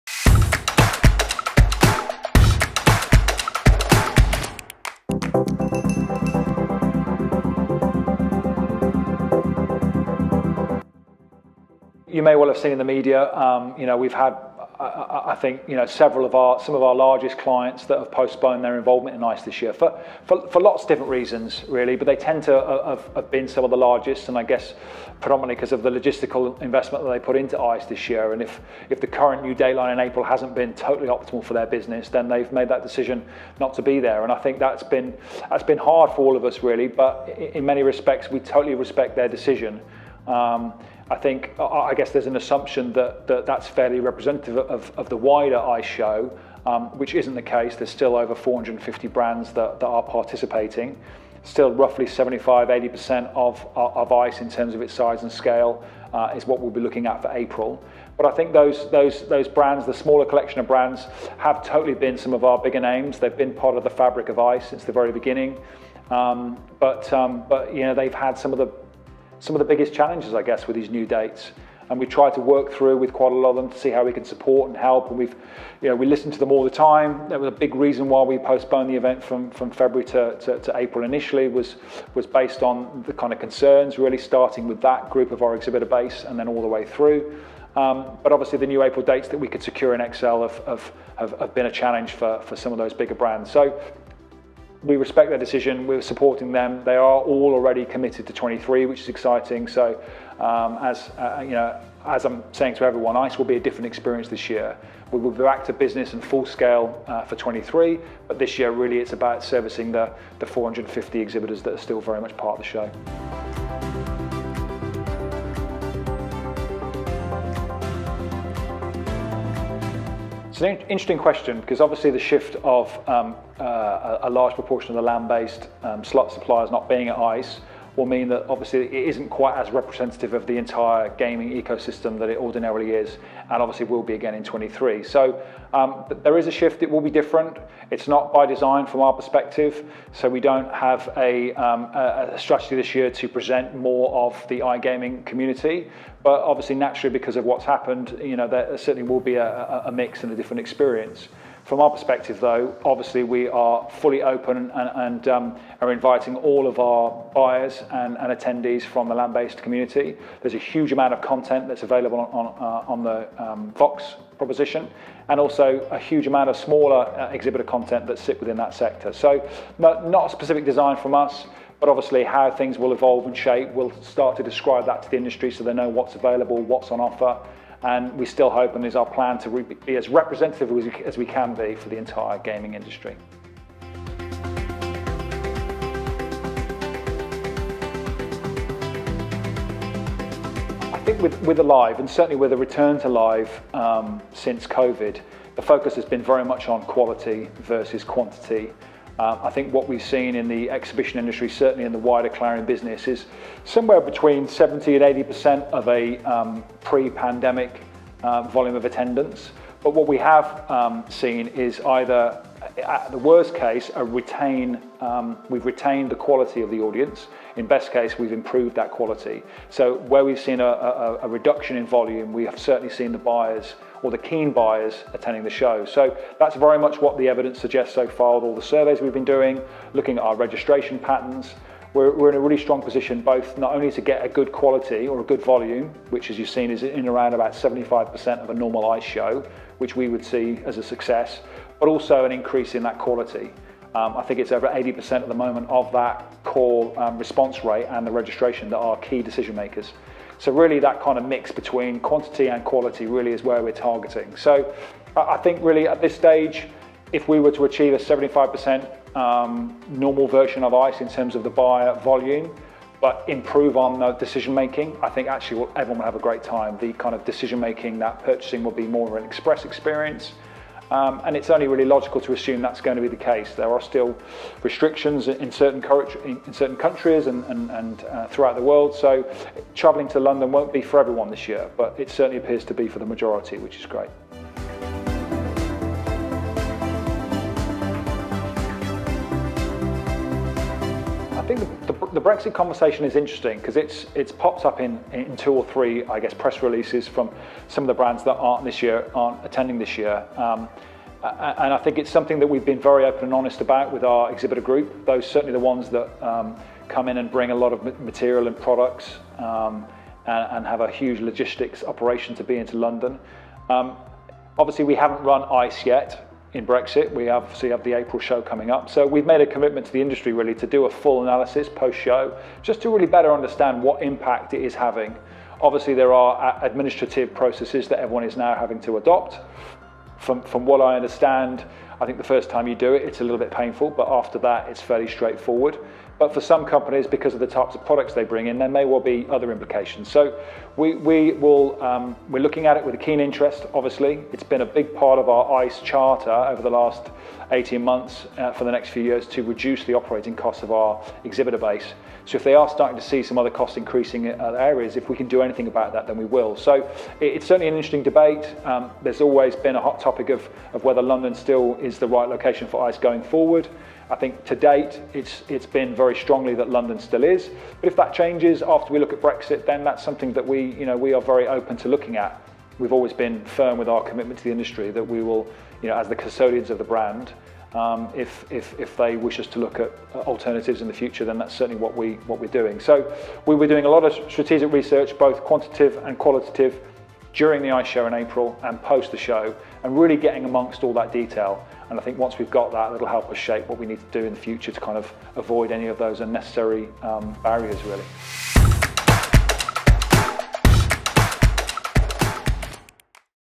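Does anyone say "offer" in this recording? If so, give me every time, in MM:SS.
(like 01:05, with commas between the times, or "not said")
02:56.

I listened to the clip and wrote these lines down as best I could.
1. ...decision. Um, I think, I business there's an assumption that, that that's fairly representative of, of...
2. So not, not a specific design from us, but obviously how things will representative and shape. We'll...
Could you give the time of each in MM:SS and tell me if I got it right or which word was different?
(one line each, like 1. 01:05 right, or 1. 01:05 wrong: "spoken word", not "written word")
1. 00:39 wrong: "guess", not "business"
2. 02:49 wrong: "evolve", not "representative".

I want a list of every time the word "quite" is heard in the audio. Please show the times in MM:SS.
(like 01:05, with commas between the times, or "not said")
01:13, 02:09.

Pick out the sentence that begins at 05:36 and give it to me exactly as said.
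But for some companies, because of the types of products they bring in, there may well be other implications.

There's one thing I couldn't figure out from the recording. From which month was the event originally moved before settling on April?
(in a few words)
February.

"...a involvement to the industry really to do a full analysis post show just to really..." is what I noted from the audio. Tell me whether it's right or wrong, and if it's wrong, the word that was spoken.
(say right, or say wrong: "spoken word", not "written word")
wrong: "commitment", not "involvement".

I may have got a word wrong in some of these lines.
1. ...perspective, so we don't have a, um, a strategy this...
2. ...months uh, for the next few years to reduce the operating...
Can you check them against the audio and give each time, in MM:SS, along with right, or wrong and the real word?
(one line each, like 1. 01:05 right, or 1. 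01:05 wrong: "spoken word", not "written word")
1. 02:19 right
2. 05:47 right.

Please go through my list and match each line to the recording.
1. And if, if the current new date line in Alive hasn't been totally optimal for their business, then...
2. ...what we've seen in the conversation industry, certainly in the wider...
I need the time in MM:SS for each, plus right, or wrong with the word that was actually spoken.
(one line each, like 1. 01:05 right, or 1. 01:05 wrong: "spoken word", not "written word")
1. 00:28 wrong: "April", not "Alive"
2. 03:19 wrong: "exhibition", not "conversation".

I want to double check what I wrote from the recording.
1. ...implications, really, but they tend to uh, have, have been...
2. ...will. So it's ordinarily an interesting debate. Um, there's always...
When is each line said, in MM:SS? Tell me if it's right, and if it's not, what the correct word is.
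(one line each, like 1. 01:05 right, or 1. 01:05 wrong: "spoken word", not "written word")
1. 00:21 wrong: "reasons", not "implications"
2. 05:56 wrong: "certainly", not "ordinarily".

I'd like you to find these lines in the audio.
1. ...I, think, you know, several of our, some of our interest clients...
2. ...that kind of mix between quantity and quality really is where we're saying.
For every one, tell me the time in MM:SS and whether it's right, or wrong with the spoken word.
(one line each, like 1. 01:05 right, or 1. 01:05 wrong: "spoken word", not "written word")
1. 00:15 wrong: "largest", not "interest"
2. 04:10 wrong: "targeting", not "saying".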